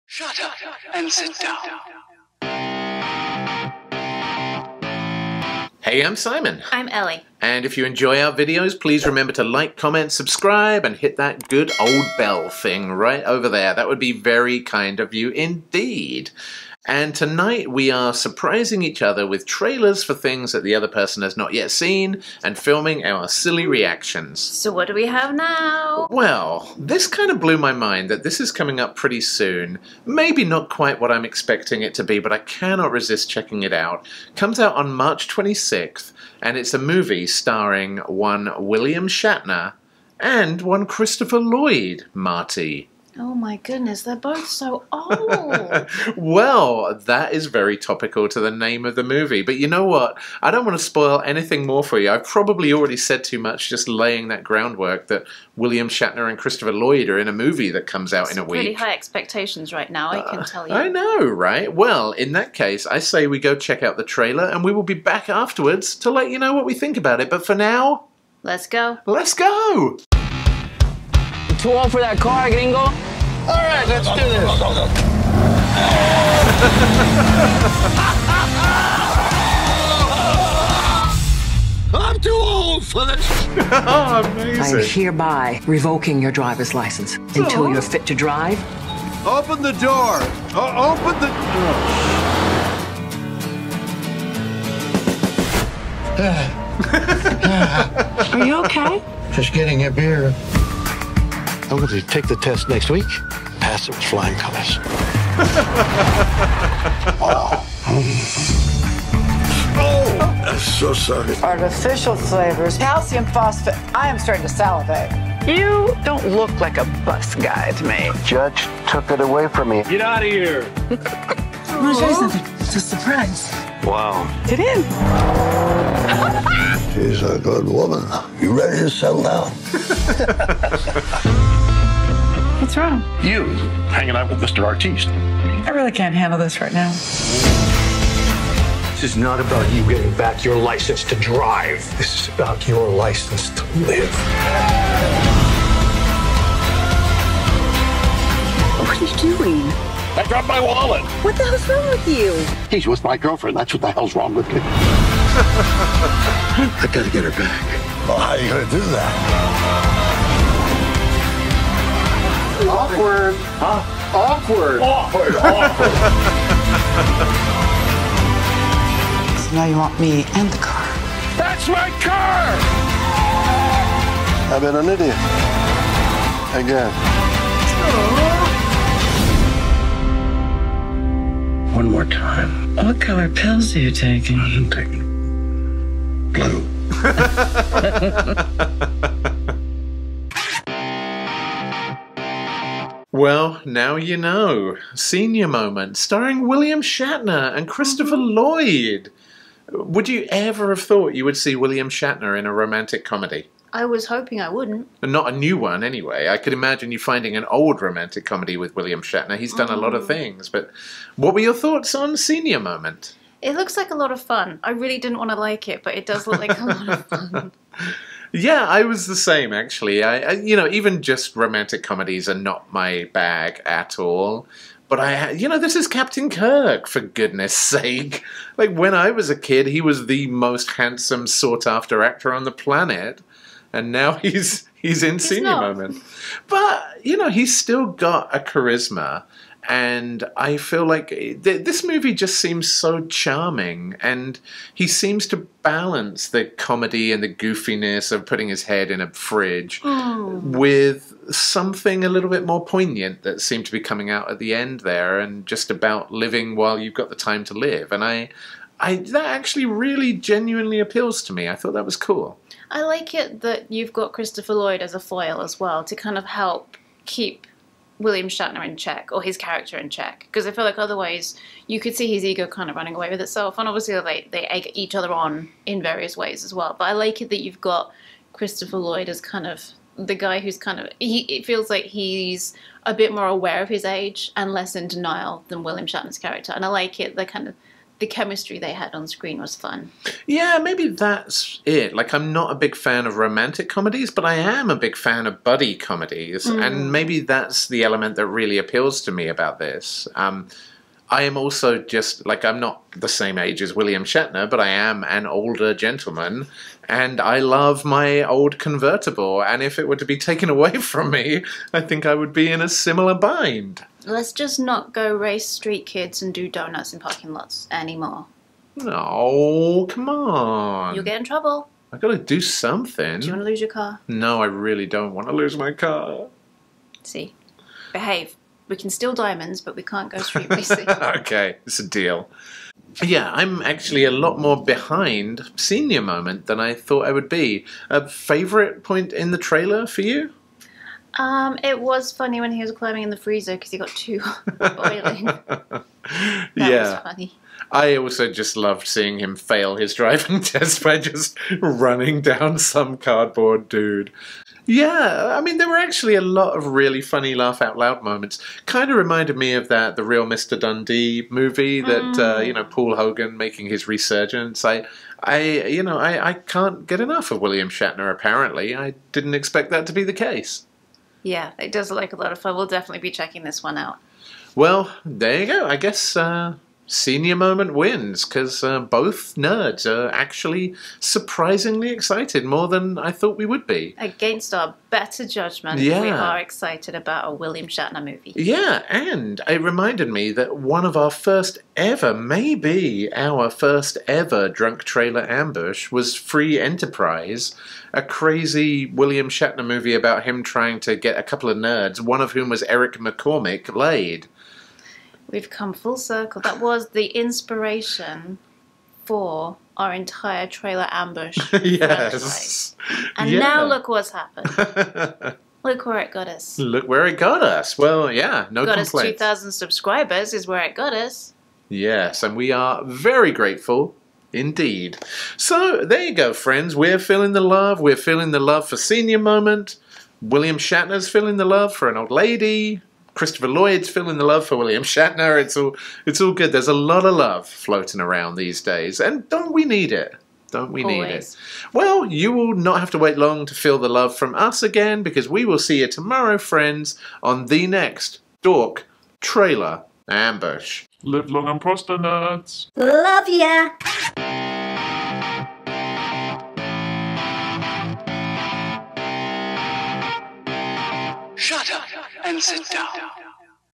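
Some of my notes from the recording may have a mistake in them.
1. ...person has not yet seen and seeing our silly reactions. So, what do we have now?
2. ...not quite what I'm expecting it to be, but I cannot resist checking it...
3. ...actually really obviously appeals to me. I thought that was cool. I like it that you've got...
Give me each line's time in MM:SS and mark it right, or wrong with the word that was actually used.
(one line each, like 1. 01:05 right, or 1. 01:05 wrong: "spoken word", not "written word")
1. 00:20 wrong: "filming", not "seeing"
2. 00:30 right
3. 04:19 wrong: "genuinely", not "obviously".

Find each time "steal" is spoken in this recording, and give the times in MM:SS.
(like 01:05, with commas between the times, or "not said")
05:28.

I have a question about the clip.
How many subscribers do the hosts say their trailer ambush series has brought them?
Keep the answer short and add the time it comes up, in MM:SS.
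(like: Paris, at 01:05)
2,000, at 06:59.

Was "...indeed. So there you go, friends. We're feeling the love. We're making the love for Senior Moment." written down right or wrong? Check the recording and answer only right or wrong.
wrong.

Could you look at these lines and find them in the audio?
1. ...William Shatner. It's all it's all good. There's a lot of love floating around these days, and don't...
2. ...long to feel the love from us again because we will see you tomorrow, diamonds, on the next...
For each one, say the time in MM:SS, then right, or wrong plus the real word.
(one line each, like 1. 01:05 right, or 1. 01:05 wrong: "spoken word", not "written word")
1. 07:14 right
2. 07:23 wrong: "friends", not "diamonds".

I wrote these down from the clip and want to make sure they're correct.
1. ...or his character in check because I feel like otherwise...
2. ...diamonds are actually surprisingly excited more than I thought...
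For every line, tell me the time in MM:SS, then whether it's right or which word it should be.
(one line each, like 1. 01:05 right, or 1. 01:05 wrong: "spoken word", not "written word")
1. 04:29 right
2. 06:19 wrong: "nerds", not "diamonds".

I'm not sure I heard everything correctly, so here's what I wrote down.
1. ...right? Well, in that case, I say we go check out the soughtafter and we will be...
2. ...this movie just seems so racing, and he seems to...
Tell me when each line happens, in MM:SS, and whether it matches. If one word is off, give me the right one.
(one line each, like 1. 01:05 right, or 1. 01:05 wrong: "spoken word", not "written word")
1. 01:01 wrong: "trailer", not "soughtafter"
2. 04:01 wrong: "charming", not "racing".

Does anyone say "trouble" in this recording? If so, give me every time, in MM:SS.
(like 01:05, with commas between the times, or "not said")
05:21.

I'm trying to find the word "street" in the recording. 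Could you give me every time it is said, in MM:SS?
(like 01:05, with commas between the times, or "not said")
05:15, 05:30.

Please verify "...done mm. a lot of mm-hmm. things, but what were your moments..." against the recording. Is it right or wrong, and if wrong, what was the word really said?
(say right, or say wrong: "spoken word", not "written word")
wrong: "thoughts", not "moments".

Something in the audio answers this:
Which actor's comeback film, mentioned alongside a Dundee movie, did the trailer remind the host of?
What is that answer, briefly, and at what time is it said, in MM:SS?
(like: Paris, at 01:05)
Paul Hogan, at 06:02.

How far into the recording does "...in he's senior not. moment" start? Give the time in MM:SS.
03:55.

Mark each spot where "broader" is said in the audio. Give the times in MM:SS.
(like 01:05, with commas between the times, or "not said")
not said.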